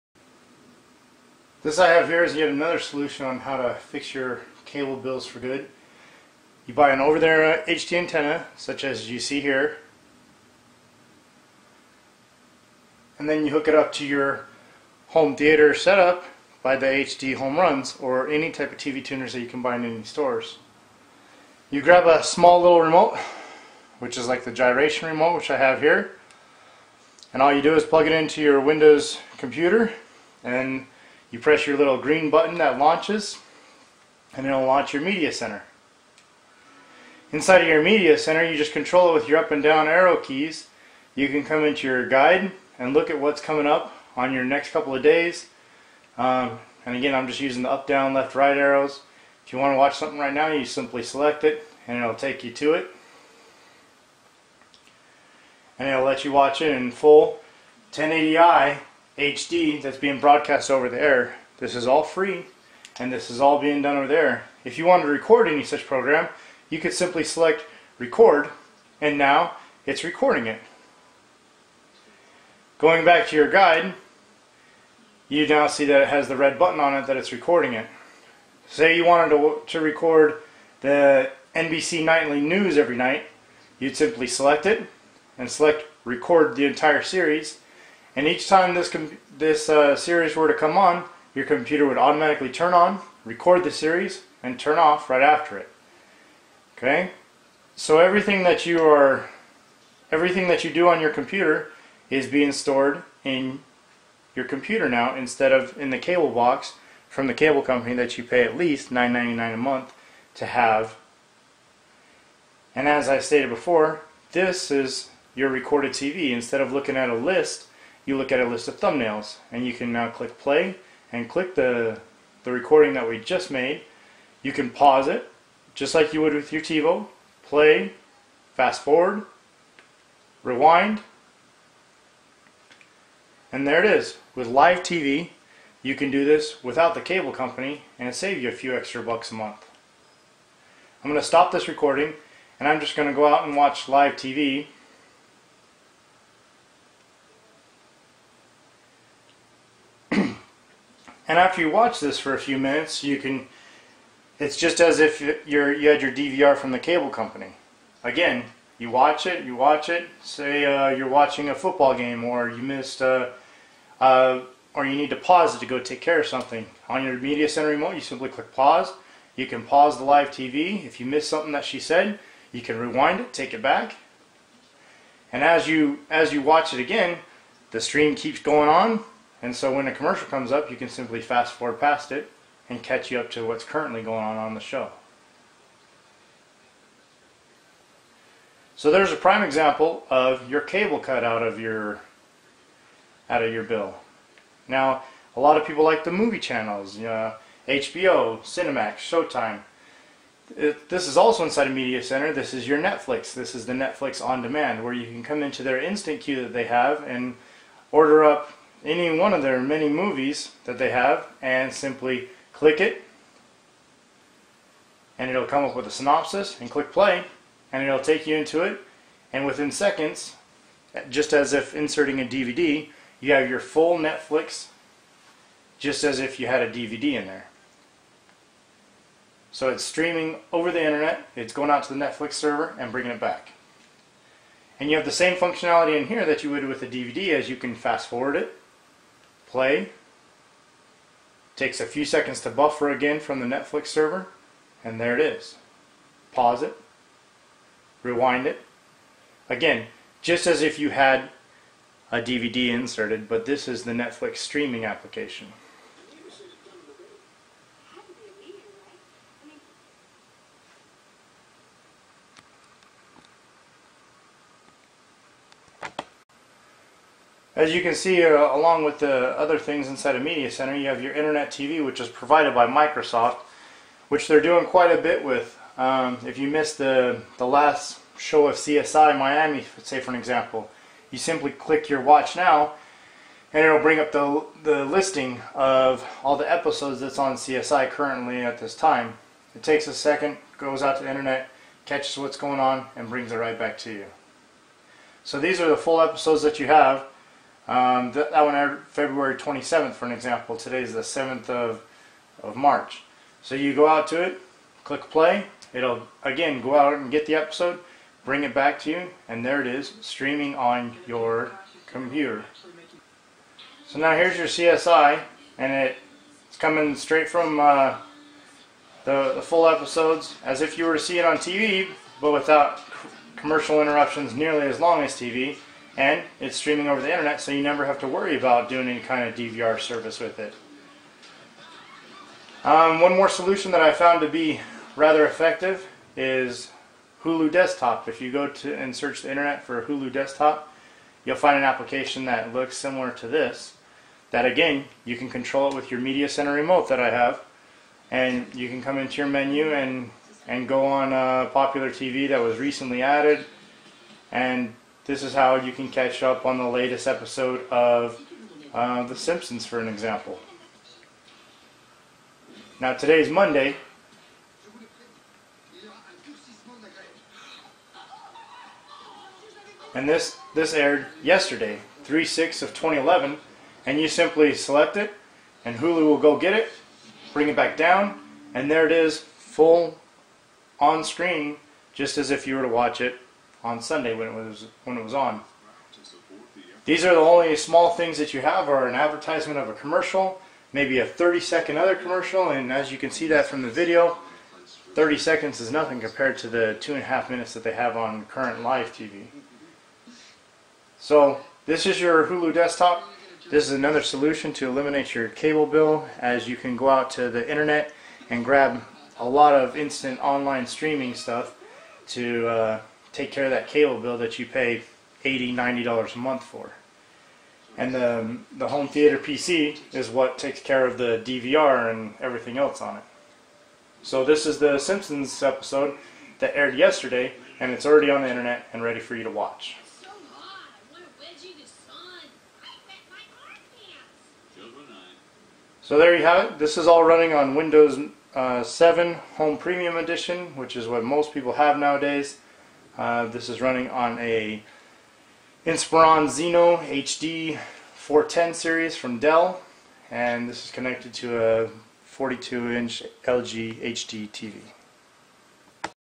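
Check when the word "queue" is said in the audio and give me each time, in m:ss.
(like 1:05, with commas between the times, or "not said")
3:26.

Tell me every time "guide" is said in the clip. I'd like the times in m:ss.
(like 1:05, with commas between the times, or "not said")
0:42, 1:13.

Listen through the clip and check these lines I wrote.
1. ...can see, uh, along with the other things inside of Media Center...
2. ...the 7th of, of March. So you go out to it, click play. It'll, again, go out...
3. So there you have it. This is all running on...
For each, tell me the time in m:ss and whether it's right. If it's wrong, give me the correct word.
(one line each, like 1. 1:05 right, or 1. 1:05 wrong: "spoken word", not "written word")
1. 4:27 right
2. 5:00 right
3. 7:15 right.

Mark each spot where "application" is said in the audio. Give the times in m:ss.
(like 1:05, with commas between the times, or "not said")
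4:14, 5:41.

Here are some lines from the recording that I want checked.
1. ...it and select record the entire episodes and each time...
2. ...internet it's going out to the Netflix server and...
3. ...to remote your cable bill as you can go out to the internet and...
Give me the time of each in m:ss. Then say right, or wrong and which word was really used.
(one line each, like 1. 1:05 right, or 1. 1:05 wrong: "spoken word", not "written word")
1. 1:24 wrong: "series", not "episodes"
2. 3:50 right
3. 6:44 wrong: "eliminate", not "remote".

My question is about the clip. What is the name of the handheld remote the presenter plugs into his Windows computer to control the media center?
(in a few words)
gyration remote.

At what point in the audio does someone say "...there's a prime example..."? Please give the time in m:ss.
3:08.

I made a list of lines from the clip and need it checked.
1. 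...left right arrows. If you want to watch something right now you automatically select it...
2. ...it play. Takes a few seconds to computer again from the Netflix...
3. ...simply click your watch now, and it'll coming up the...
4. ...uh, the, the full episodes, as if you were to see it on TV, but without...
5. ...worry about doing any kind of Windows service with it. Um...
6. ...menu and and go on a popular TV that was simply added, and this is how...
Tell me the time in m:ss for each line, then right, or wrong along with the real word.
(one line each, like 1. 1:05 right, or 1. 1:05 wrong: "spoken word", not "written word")
1. 0:48 wrong: "simply", not "automatically"
2. 3:58 wrong: "buffer", not "computer"
3. 4:41 wrong: "bring", not "coming"
4. 5:17 right
5. 5:28 wrong: "DVR", not "Windows"
6. 5:49 wrong: "recently", not "simply".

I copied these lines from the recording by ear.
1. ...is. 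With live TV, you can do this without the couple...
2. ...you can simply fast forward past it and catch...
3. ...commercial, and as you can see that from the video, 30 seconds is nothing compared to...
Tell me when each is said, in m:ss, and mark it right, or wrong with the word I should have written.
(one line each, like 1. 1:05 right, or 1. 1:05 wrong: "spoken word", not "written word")
1. 2:13 wrong: "cable", not "couple"
2. 3:00 right
3. 6:31 right.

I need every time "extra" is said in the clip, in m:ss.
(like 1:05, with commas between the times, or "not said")
2:18.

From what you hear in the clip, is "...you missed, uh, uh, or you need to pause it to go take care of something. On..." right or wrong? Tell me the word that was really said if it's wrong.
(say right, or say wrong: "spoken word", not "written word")
right.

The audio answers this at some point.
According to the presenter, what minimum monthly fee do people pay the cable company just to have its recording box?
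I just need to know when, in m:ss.
1:48.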